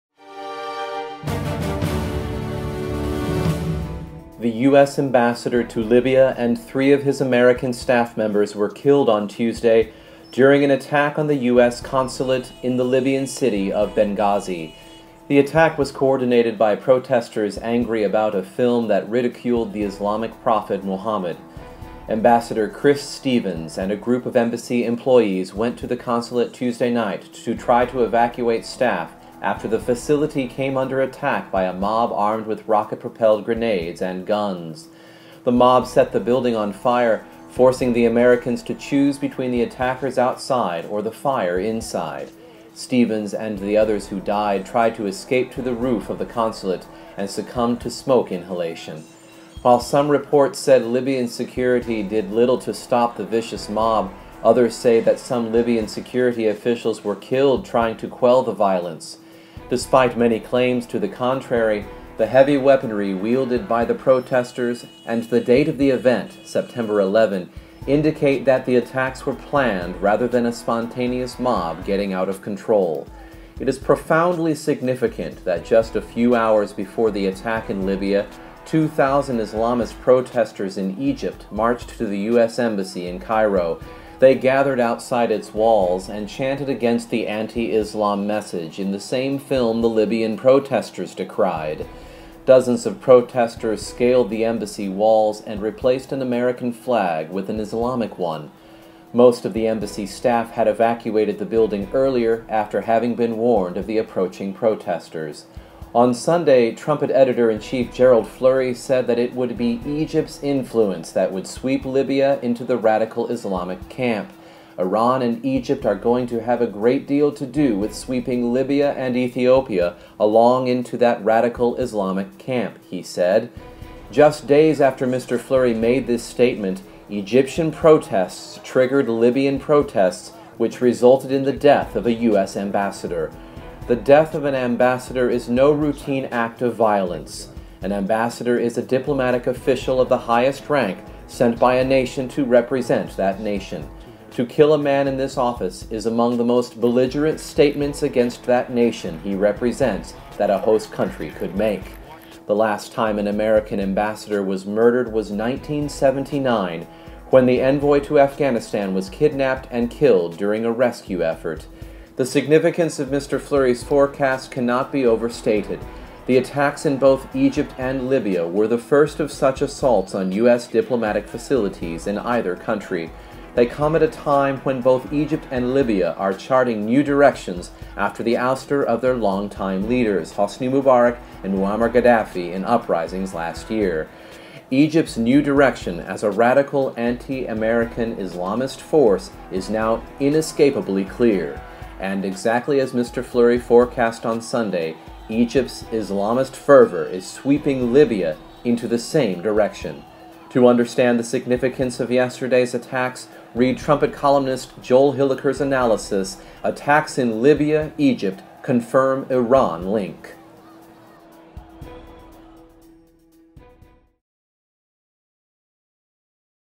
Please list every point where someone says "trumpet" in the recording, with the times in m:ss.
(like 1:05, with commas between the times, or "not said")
1:46, 3:23.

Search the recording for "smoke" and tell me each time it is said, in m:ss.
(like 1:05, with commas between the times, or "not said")
0:47.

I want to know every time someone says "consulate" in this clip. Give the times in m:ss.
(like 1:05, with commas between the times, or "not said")
0:11, 0:25, 0:46.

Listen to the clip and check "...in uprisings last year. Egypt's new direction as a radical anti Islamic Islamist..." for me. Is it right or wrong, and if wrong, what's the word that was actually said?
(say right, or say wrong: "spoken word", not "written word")
wrong: "American", not "Islamic".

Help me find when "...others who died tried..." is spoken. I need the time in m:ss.
0:43.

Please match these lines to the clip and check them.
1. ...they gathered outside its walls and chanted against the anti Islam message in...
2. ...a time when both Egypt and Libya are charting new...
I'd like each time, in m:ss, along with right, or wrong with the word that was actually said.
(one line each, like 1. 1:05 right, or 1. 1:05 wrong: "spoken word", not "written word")
1. 1:24 right
2. 2:54 right.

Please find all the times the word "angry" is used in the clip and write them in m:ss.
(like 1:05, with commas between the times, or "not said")
0:17.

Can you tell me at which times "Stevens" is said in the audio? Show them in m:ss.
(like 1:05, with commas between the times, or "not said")
0:23, 0:42.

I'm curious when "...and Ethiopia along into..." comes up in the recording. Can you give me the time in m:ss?
1:58.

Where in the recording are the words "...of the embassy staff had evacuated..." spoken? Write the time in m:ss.
1:39.